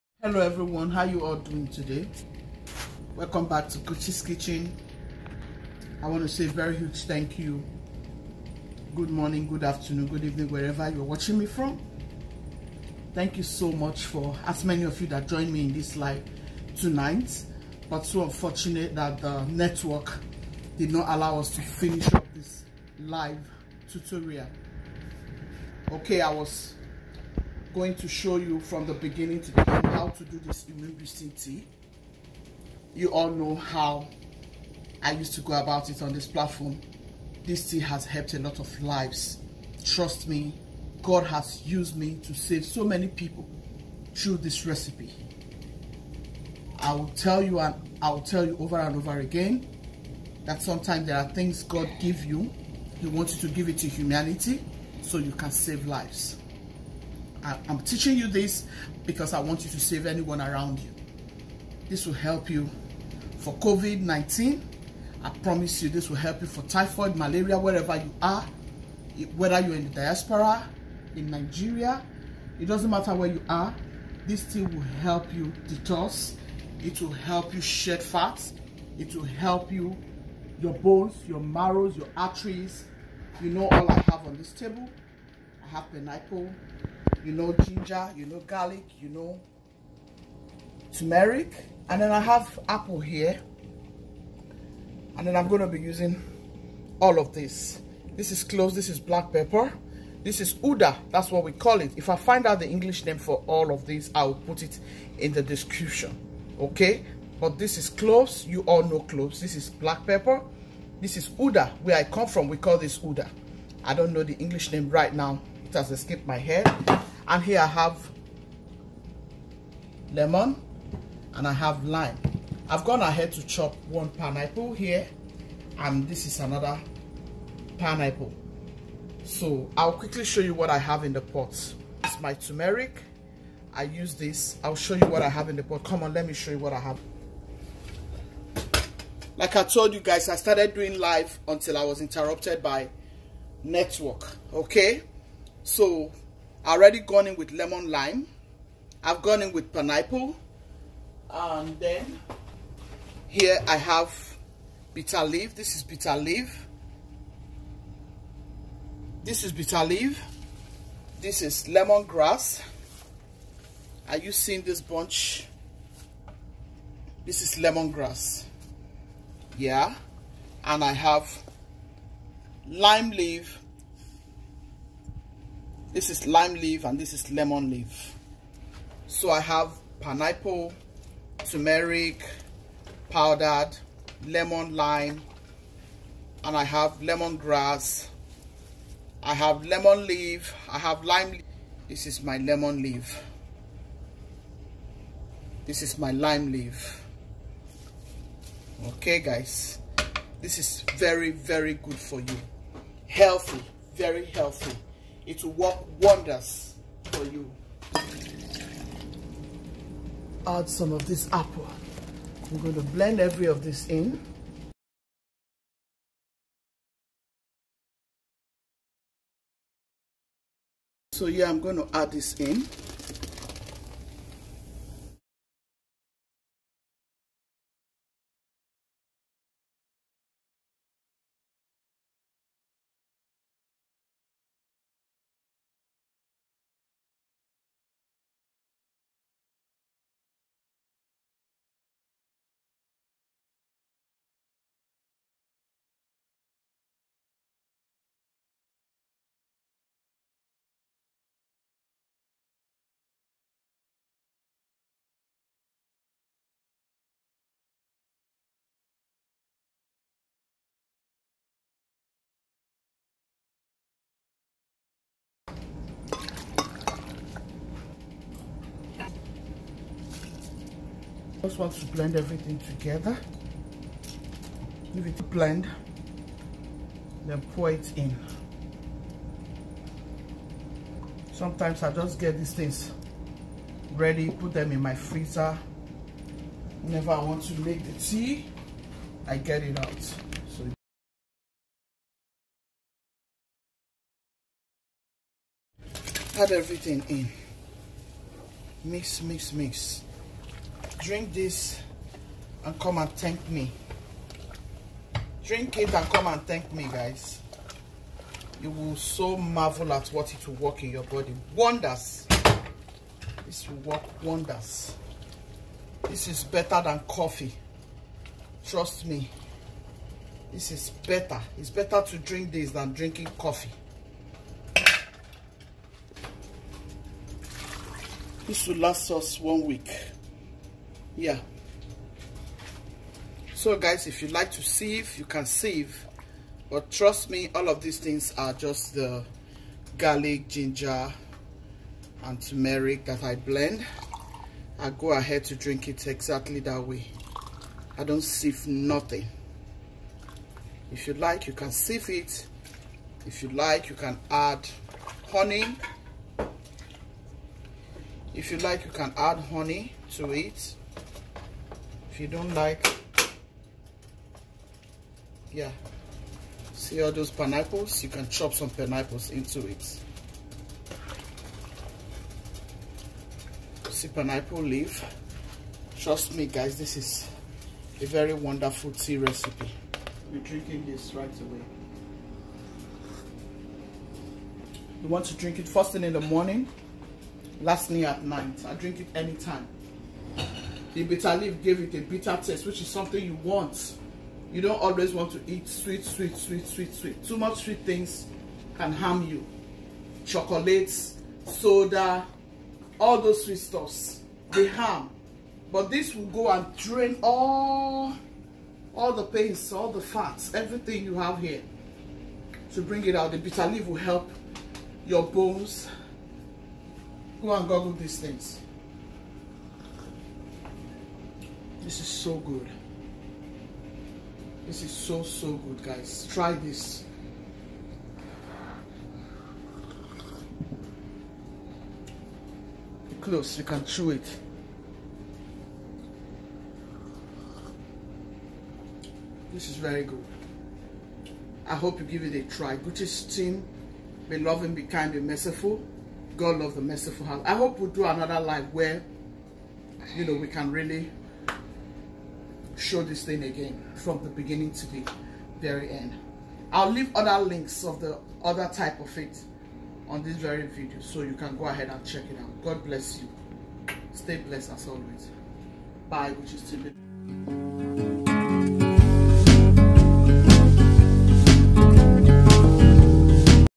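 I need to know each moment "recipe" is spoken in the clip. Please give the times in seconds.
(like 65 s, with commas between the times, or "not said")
44 s, 379 s.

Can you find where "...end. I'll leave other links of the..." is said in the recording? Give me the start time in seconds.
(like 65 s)
455 s.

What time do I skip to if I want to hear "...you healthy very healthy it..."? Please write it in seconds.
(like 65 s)
202 s.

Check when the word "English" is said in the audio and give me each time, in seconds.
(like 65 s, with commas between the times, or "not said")
102 s, 114 s.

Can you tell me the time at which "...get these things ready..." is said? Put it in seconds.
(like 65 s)
282 s.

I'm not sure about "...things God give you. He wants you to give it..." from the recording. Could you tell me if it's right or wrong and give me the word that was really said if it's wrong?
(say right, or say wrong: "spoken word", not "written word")
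right.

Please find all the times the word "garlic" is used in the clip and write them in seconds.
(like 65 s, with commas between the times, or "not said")
88 s, 339 s.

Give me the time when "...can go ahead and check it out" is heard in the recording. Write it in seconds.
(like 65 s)
461 s.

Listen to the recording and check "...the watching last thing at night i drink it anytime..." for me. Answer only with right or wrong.
wrong.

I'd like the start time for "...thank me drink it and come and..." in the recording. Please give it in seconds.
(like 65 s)
303 s.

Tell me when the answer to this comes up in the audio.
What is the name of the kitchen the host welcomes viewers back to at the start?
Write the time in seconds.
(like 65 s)
3 s.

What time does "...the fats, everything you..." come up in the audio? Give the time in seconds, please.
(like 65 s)
409 s.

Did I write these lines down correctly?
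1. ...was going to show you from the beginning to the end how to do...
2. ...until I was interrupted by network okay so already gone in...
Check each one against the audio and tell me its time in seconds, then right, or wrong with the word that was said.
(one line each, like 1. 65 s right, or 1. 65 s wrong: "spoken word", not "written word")
1. 26 s right
2. 141 s right.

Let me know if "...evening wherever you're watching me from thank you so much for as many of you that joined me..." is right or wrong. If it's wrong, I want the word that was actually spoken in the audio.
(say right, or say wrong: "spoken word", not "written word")
right.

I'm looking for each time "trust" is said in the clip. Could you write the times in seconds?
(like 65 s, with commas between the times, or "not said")
39 s, 318 s, 336 s, 375 s.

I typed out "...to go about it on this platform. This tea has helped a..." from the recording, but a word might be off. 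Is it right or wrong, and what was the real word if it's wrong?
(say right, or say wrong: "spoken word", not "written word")
right.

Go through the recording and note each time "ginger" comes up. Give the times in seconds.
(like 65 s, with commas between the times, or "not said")
87 s, 340 s.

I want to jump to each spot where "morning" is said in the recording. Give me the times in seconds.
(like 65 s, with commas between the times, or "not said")
9 s, 386 s.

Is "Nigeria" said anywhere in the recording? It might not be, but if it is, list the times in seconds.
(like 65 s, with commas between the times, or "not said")
71 s.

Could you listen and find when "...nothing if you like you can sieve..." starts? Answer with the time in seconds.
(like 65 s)
348 s.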